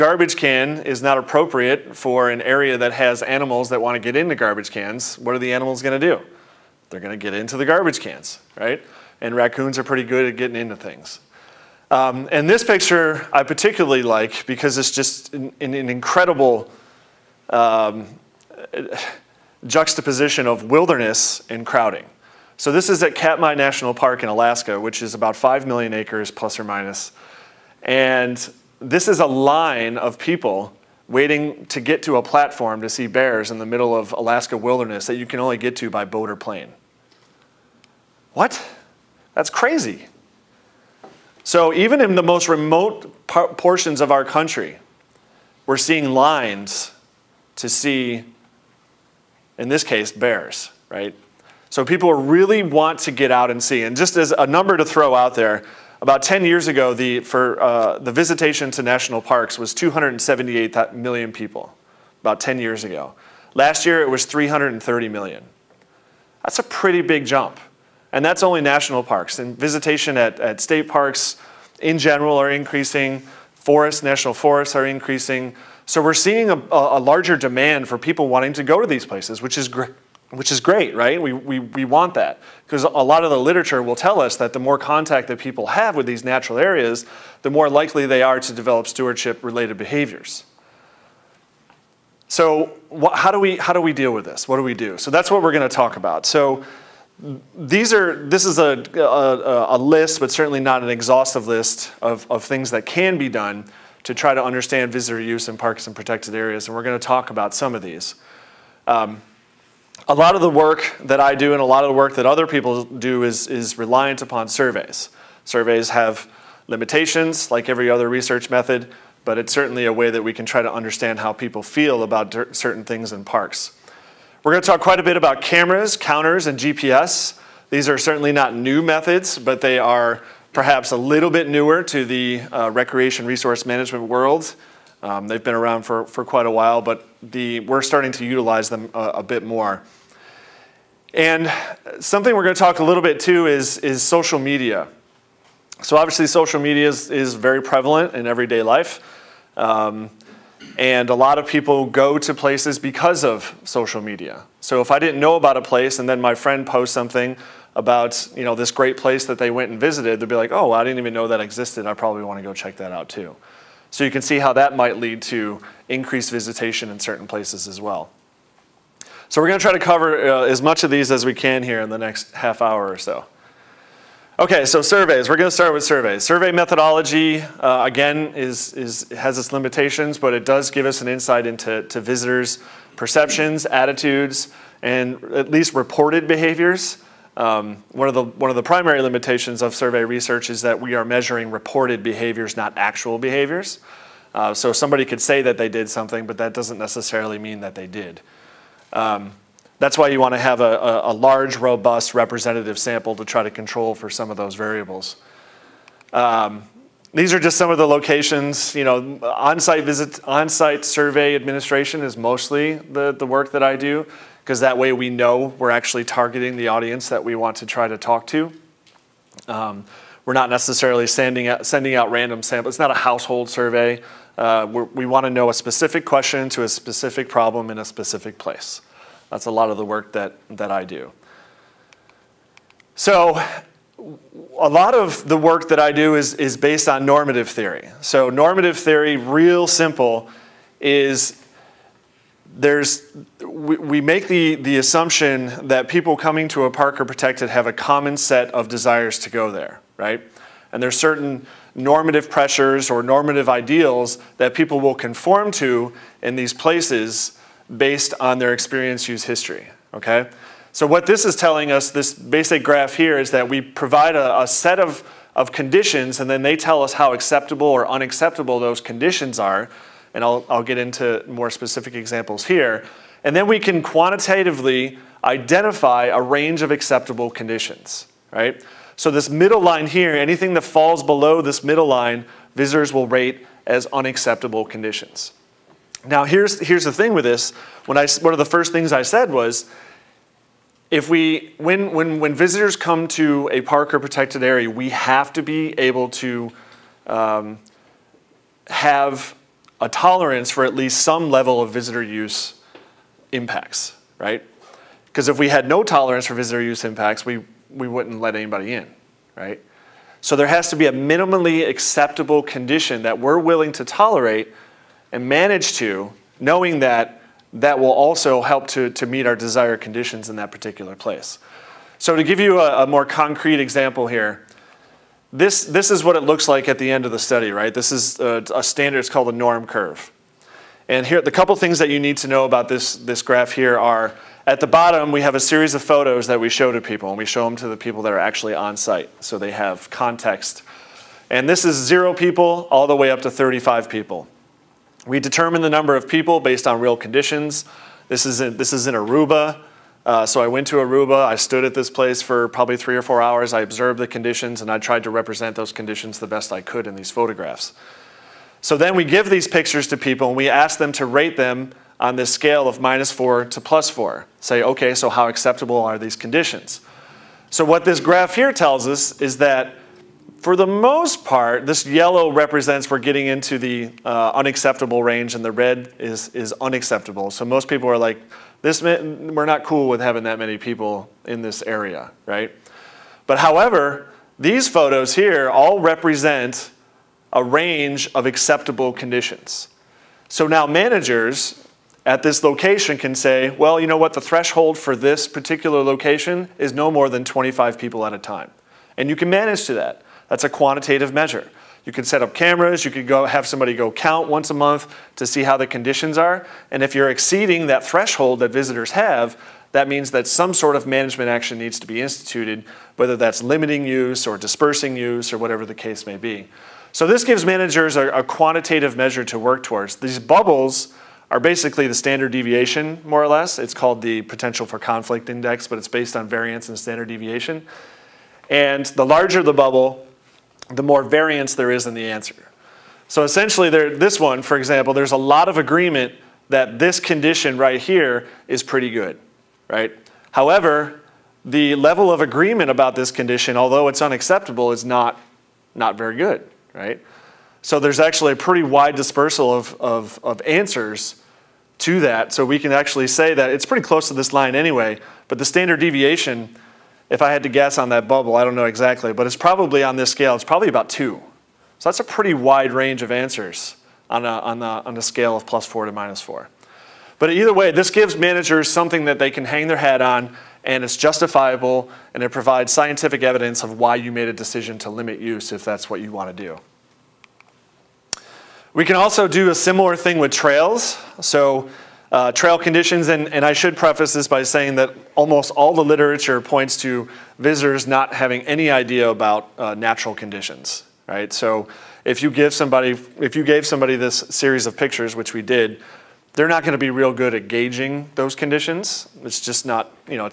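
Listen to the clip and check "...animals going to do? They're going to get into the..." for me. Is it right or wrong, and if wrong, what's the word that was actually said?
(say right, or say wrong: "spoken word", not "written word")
right.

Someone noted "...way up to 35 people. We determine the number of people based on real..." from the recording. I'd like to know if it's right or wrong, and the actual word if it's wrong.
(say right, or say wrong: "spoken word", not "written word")
right.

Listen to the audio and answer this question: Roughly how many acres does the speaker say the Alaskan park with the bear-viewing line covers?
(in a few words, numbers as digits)
5 million acres.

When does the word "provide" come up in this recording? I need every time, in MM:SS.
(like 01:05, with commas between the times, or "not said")
04:23, 07:52.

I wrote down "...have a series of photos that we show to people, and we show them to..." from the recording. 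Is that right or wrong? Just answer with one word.
right.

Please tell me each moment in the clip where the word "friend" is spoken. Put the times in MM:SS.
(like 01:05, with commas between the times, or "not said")
02:36.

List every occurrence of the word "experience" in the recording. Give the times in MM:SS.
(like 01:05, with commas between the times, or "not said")
04:18.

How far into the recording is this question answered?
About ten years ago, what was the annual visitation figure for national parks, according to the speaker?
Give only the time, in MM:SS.
00:59.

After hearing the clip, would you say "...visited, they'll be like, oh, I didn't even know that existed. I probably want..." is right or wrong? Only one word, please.
right.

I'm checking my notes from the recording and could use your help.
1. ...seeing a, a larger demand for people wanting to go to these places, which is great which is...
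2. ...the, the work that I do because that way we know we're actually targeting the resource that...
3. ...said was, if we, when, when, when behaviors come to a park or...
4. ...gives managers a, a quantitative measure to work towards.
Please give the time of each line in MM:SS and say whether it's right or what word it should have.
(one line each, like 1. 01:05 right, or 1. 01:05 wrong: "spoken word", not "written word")
1. 01:16 right
2. 03:32 wrong: "audience", not "resource"
3. 04:49 wrong: "visitors", not "behaviors"
4. 06:57 right.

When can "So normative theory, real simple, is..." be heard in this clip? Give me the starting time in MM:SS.
03:58.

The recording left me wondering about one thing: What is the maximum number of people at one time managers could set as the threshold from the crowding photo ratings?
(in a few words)
25 people.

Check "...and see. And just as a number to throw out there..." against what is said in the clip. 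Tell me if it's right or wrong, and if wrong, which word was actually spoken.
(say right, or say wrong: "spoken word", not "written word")
right.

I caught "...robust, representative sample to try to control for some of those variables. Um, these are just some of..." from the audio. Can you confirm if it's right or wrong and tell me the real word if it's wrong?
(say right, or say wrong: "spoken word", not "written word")
right.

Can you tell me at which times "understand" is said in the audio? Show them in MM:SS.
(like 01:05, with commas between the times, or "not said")
01:44, 02:00.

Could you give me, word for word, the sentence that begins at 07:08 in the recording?
And the larger the bubble, the more variance there is in the answer.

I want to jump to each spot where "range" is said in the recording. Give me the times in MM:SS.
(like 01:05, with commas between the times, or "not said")
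04:36, 06:15, 06:27, 07:42.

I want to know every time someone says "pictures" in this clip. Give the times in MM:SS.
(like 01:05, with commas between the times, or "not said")
00:12, 05:59, 08:14.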